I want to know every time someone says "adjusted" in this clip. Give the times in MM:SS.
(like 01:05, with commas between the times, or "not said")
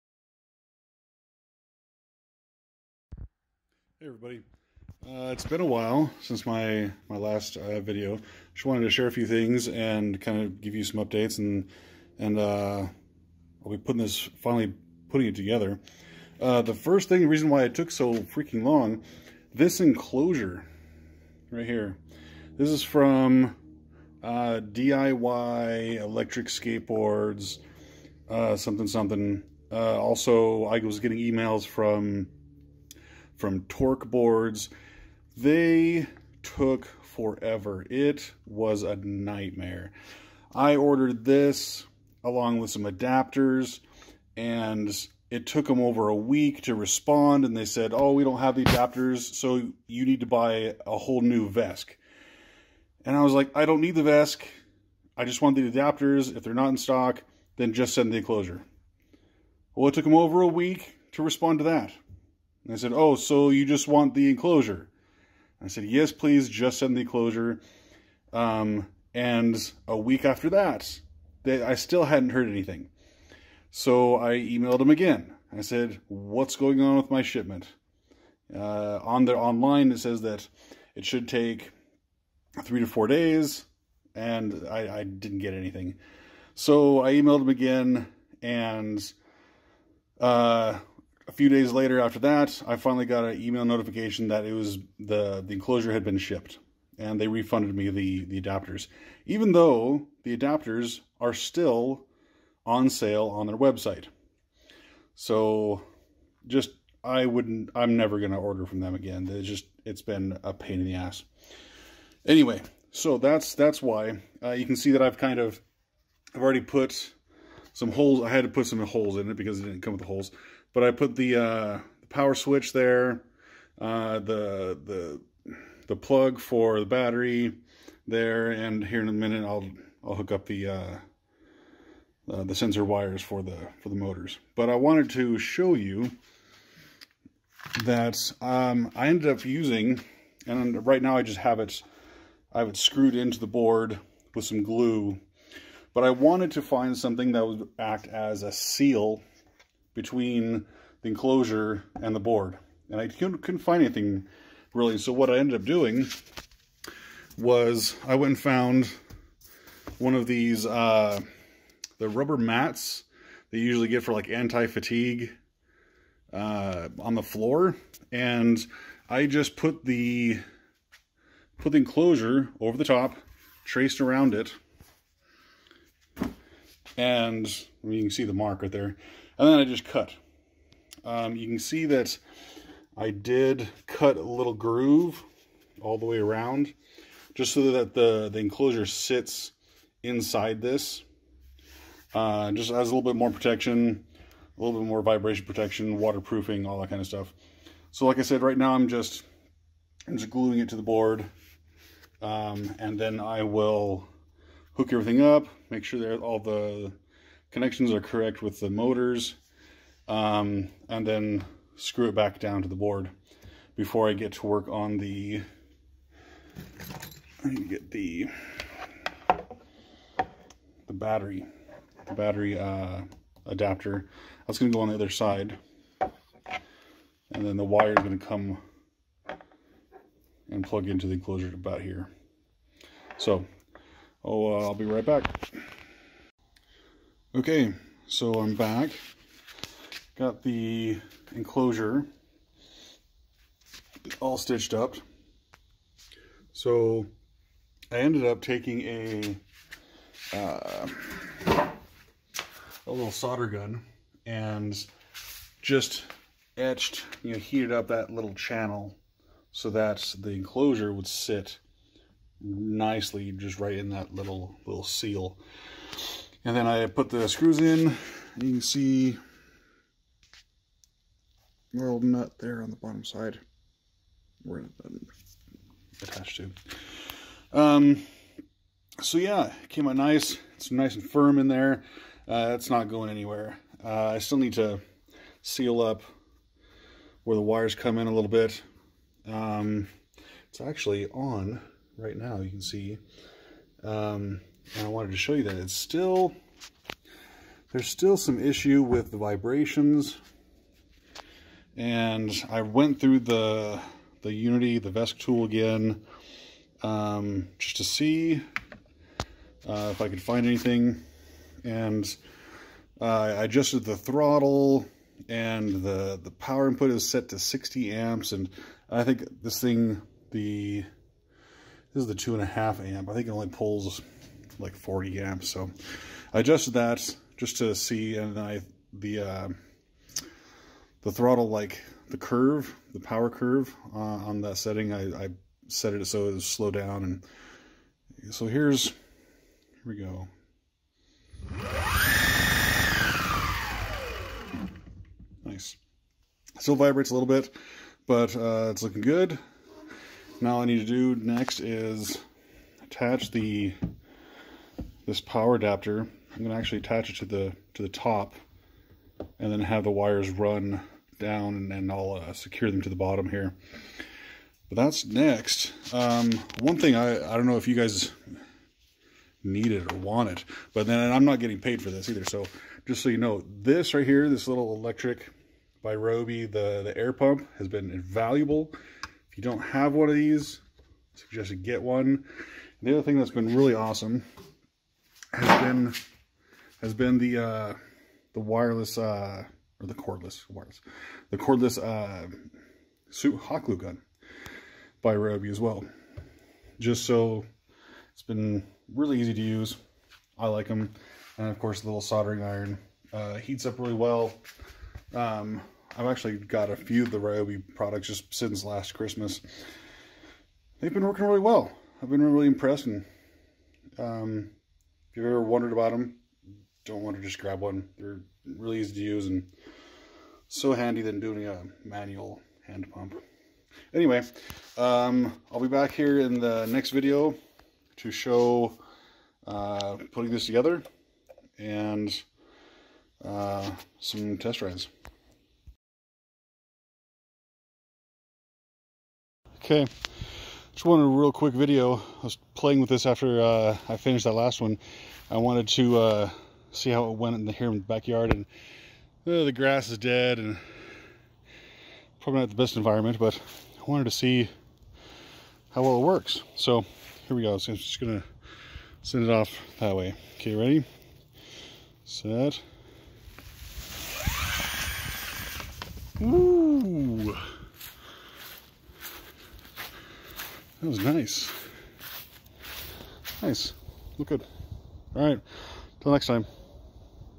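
05:13, 05:26.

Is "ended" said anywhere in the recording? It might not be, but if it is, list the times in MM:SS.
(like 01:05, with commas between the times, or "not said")
02:19, 02:35, 04:07.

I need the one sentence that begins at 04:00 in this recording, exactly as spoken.
Got the enclosure all stitched up.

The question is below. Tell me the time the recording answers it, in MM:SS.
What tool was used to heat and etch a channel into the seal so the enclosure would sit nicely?
04:13.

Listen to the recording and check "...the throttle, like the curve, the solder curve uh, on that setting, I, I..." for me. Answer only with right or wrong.
wrong.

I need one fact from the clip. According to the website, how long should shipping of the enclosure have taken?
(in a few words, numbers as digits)
3 to 4 days.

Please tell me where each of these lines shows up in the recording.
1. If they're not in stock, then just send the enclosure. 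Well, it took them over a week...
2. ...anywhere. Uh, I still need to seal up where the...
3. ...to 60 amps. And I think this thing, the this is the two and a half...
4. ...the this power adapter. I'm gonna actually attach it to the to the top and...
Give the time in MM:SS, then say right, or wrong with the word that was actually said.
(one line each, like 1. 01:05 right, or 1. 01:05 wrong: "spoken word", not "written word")
1. 00:56 right
2. 04:43 right
3. 05:17 right
4. 05:53 right.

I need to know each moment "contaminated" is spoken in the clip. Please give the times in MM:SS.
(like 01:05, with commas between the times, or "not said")
not said.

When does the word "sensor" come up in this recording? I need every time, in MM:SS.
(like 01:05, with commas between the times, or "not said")
02:12.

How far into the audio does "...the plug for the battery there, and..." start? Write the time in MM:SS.
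02:05.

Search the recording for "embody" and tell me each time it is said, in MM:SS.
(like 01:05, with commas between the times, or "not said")
not said.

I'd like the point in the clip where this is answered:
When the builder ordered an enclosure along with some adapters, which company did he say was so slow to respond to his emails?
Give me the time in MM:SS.
00:33.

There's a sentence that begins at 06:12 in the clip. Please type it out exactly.
So just so you know, this right here, this little electric by Ryobi, the, the air pump has been invaluable.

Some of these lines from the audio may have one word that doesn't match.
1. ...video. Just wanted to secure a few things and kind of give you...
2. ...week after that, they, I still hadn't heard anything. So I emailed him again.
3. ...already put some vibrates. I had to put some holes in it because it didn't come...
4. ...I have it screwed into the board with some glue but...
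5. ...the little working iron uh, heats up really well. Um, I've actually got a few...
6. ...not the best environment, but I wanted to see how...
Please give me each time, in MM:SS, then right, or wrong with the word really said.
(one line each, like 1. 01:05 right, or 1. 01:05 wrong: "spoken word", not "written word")
1. 00:07 wrong: "share", not "secure"
2. 01:09 right
3. 01:56 wrong: "holes", not "vibrates"
4. 02:22 right
5. 06:41 wrong: "soldering", not "working"
6. 07:32 right.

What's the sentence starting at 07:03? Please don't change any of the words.
Anyway, um, I'll be back here in the next video to show uh, putting this together and uh, some test rides.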